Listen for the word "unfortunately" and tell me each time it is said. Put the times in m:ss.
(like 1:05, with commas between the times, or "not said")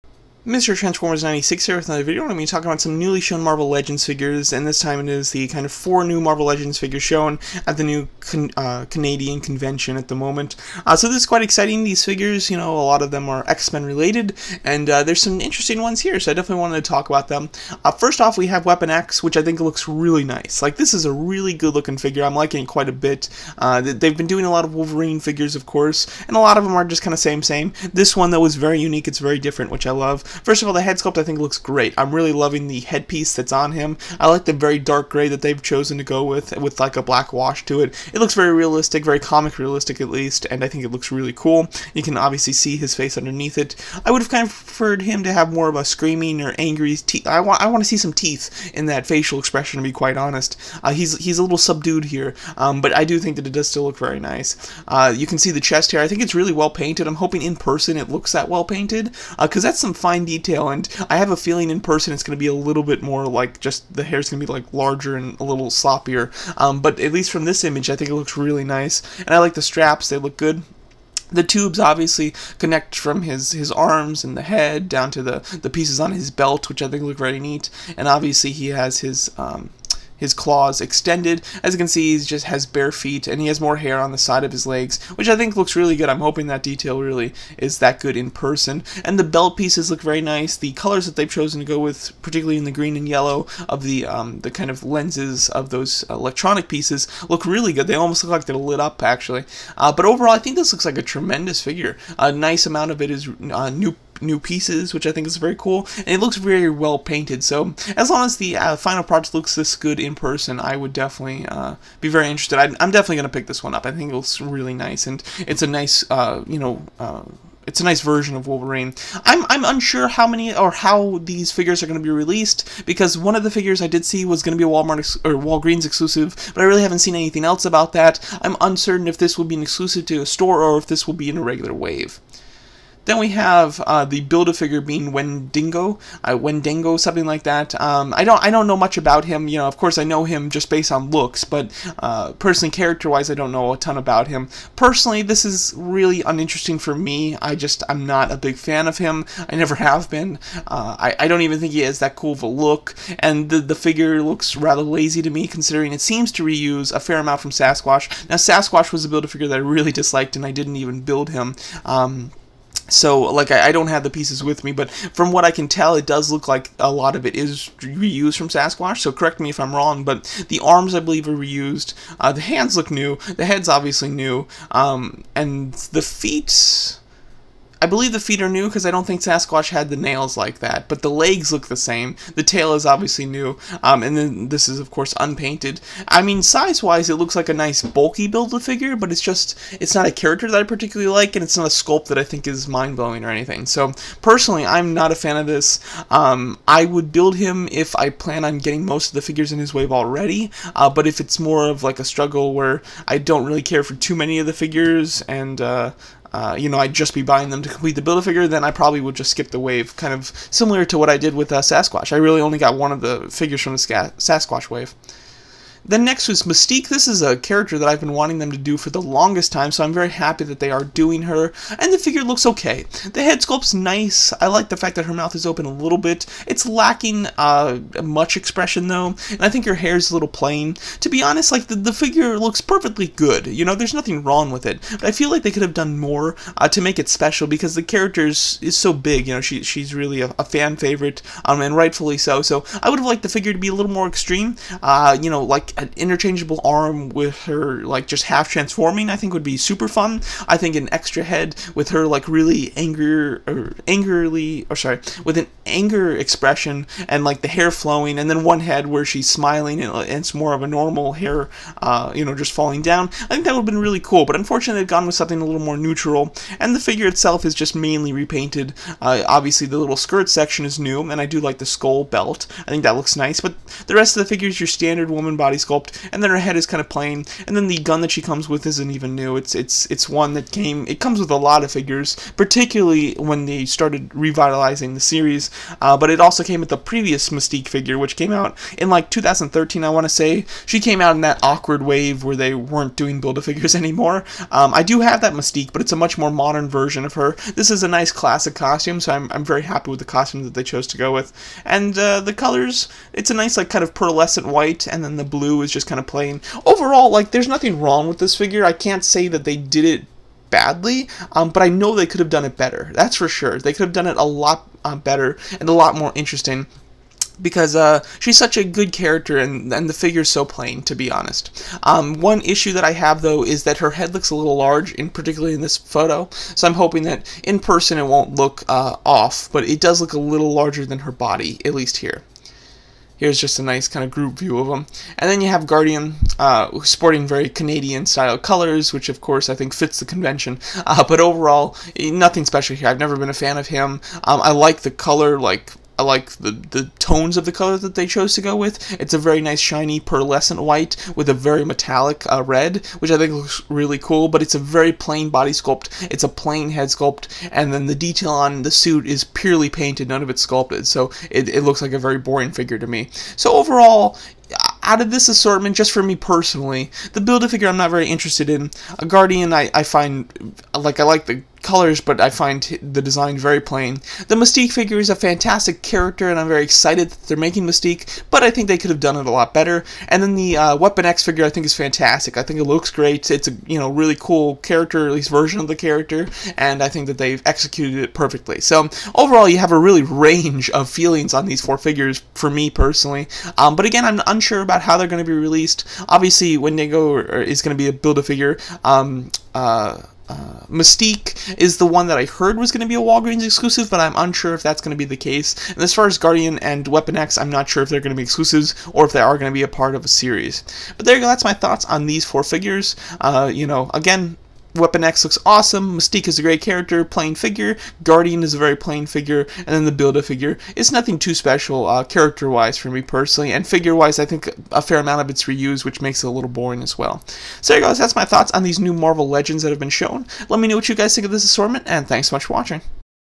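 4:24.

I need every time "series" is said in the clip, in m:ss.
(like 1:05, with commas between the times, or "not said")
4:44, 6:50.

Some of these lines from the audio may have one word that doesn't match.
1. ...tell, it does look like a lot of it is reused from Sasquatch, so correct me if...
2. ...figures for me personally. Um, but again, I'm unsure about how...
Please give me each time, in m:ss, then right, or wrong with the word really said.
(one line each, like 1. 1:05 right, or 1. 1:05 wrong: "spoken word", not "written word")
1. 2:45 right
2. 6:31 right.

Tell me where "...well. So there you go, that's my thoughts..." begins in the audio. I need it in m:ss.
7:06.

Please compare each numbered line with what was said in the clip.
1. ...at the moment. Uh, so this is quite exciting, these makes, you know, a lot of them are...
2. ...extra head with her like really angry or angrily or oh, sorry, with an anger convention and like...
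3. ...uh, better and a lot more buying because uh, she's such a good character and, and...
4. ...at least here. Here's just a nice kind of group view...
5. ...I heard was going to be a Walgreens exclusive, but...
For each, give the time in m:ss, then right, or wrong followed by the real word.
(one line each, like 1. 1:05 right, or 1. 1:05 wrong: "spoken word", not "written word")
1. 0:09 wrong: "figures", not "makes"
2. 4:10 wrong: "expression", not "convention"
3. 5:14 wrong: "interesting", not "buying"
4. 5:31 right
5. 6:42 right.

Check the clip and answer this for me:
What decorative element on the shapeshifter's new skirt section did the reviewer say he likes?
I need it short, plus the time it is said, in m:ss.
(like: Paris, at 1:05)
Skull belt, at 4:31.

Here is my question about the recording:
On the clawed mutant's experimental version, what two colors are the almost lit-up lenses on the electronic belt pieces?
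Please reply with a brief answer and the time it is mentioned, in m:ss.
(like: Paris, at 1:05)
Green and yellow, at 1:32.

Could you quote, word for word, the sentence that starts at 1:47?
So as long as the uh, final product looks this good in person, I would definitely uh, be very interested.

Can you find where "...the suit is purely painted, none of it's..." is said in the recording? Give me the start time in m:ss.
5:58.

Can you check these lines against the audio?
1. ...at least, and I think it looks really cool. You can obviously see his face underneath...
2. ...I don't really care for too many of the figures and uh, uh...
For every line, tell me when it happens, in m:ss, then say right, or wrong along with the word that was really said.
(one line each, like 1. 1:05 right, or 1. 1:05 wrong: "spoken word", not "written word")
1. 0:40 right
2. 3:23 right.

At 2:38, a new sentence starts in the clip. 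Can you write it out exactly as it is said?
Now Sasquatch was a Build-A-Figure that I really disliked, and I didn't even build him.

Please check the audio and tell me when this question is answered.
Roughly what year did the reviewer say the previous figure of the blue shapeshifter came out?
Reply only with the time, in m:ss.
4:49.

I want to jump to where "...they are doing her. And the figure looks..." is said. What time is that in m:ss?
3:40.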